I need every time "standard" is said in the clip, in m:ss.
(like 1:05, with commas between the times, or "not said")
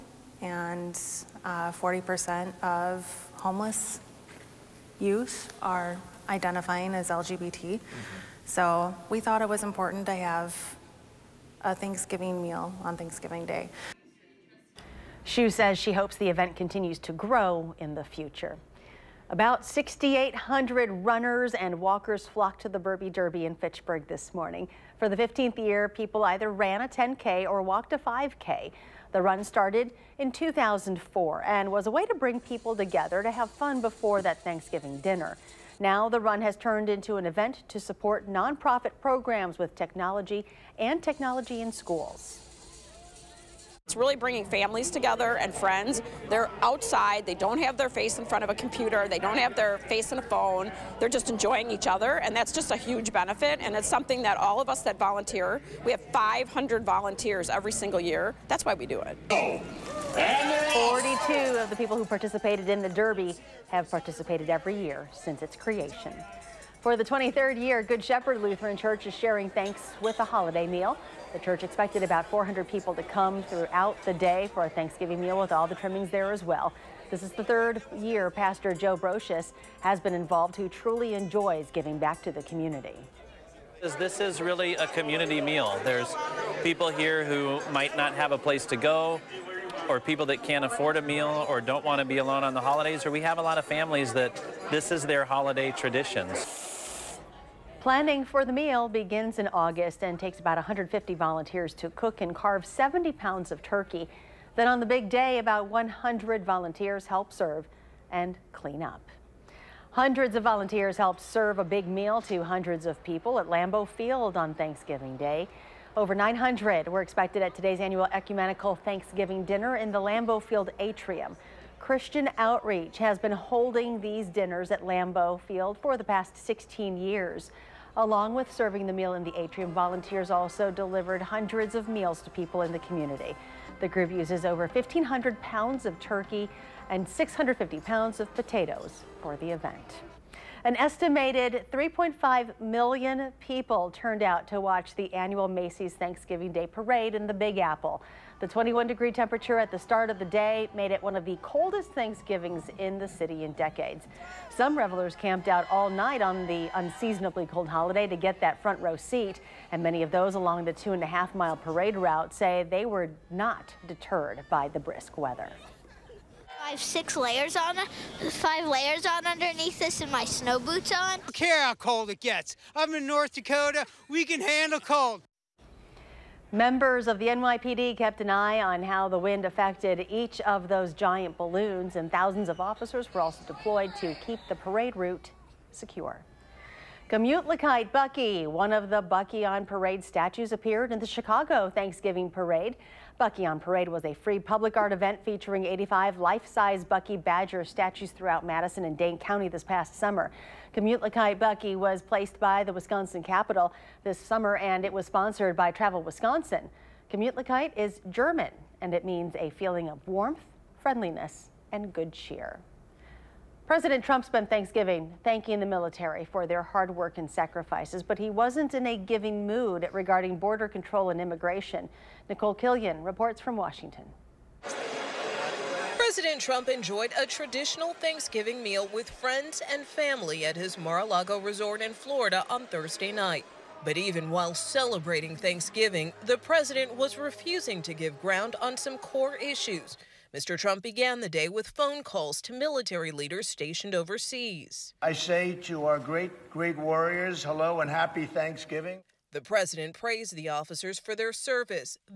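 not said.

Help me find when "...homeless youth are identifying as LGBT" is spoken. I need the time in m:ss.
0:03.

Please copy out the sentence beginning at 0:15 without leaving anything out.
Shu says she hopes the event continues to grow in the future.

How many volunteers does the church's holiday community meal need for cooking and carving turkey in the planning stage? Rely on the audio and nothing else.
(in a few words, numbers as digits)
150.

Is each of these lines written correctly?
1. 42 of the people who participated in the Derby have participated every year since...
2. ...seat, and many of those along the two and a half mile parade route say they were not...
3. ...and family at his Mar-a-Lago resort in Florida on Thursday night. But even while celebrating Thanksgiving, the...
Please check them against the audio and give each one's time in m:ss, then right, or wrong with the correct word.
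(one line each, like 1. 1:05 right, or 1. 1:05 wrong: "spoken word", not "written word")
1. 1:00 right
2. 2:38 right
3. 3:49 right.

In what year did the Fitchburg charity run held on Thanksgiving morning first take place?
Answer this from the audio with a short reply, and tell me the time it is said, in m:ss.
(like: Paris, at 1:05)
2004, at 0:30.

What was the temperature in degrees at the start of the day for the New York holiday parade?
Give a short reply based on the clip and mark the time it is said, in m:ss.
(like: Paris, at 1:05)
21, at 2:28.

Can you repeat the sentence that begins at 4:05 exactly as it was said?
I say to our great, great warriors, hello and happy Thanksgiving.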